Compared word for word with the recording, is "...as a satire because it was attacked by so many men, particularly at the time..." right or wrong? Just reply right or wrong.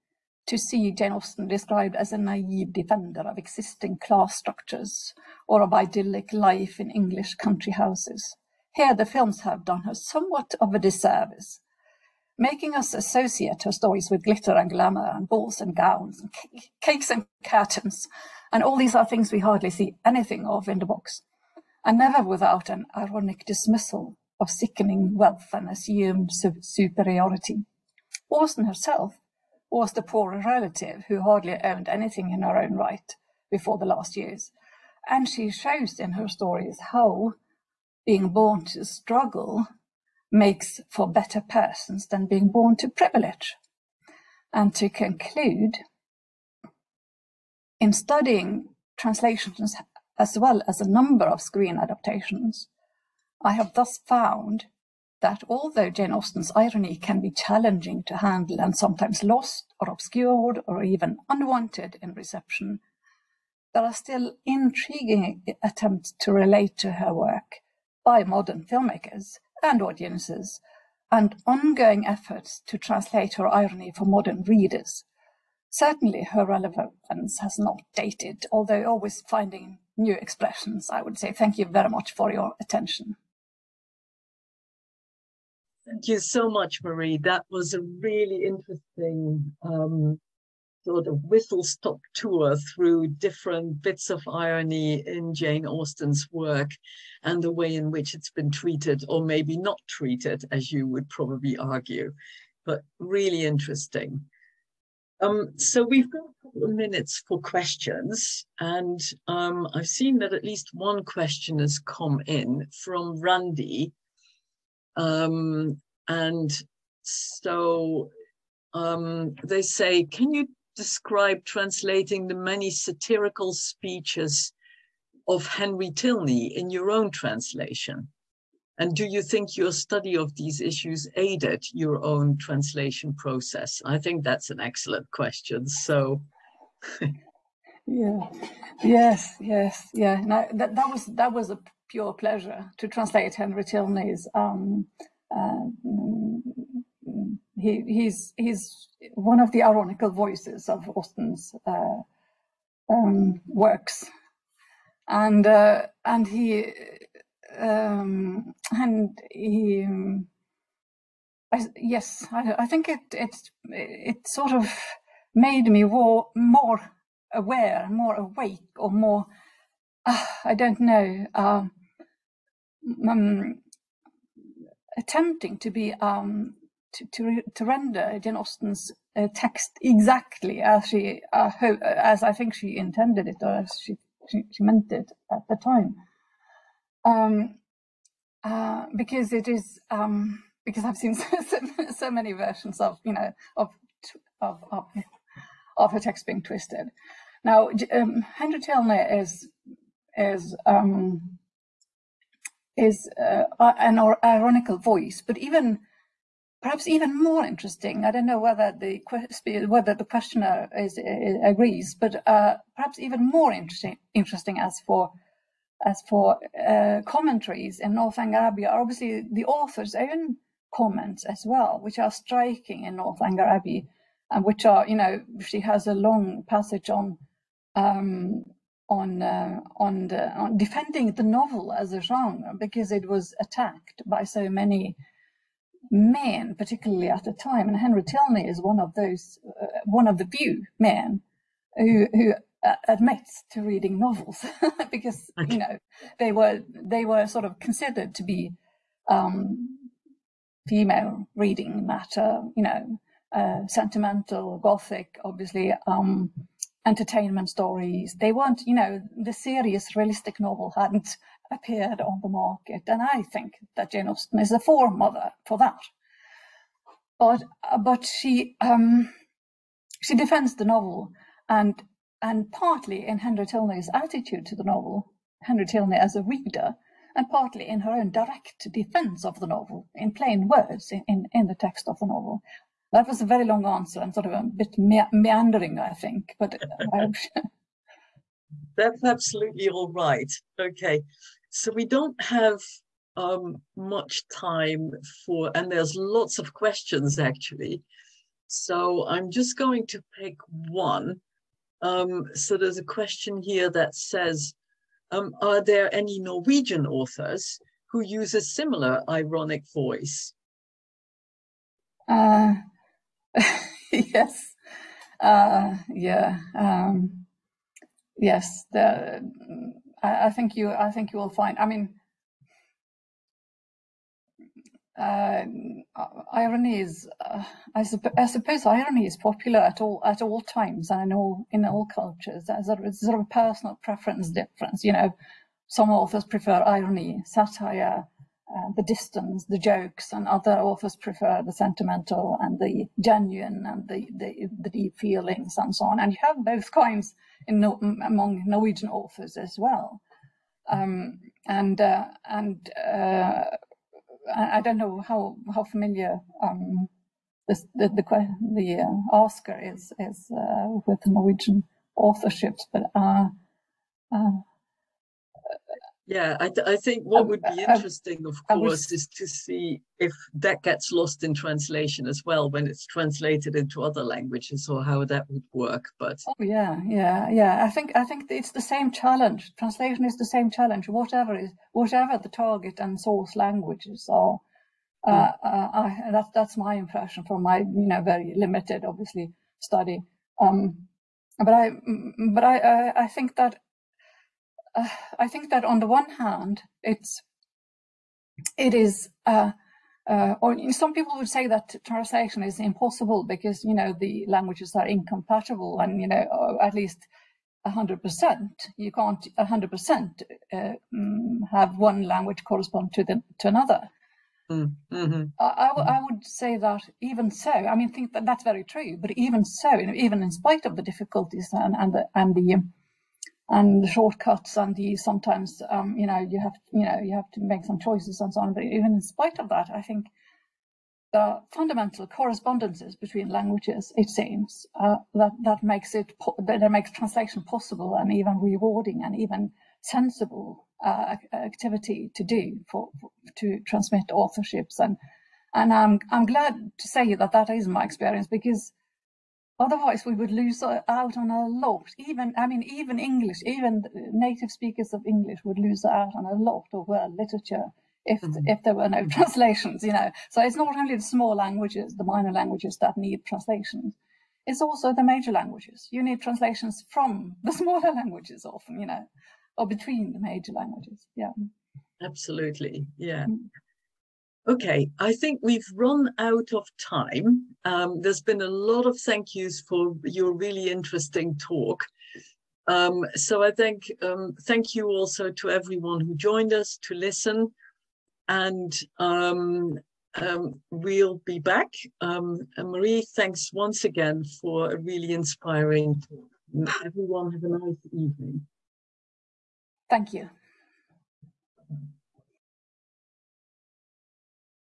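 wrong.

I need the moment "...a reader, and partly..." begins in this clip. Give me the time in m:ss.
4:36.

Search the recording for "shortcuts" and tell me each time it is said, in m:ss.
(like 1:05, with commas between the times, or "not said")
7:03.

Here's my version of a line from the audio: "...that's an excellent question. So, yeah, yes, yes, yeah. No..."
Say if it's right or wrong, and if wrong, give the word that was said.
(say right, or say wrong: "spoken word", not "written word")
right.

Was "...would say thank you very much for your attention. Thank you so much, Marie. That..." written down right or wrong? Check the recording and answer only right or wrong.
right.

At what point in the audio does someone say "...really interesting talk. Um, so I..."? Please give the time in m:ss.
8:00.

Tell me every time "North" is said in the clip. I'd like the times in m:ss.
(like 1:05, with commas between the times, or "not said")
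3:37, 3:42.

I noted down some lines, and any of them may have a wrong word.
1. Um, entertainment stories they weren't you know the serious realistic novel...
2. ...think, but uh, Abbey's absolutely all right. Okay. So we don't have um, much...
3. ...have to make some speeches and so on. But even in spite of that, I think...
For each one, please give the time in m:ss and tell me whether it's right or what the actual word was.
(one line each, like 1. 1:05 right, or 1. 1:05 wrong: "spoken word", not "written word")
1. 4:15 right
2. 4:45 wrong: "That", not "Abbey"
3. 7:07 wrong: "choices", not "speeches".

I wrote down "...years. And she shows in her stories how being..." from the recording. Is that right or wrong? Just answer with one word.
right.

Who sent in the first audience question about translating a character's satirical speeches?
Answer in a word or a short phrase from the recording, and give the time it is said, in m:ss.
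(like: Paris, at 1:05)
Randy, at 1:53.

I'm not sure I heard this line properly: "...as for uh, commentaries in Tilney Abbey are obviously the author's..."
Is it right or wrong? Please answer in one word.
wrong.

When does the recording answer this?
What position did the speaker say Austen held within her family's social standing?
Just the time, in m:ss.
0:29.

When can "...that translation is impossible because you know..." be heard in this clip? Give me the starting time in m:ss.
6:41.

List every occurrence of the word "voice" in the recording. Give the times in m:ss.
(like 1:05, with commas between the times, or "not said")
2:30, 3:24, 5:09.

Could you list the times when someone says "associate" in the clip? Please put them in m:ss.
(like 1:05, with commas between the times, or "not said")
0:12.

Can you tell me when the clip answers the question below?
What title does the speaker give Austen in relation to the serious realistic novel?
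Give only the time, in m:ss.
4:24.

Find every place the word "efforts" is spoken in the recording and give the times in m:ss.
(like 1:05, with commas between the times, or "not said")
1:12.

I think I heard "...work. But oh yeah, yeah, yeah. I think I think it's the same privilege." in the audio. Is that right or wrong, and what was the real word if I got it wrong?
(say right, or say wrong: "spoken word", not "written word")
wrong: "challenge", not "privilege".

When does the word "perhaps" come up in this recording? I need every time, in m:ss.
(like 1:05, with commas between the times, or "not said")
3:26, 3:32.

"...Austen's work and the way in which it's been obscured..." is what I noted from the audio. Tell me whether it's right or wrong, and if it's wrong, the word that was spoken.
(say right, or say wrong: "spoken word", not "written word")
wrong: "treated", not "obscured".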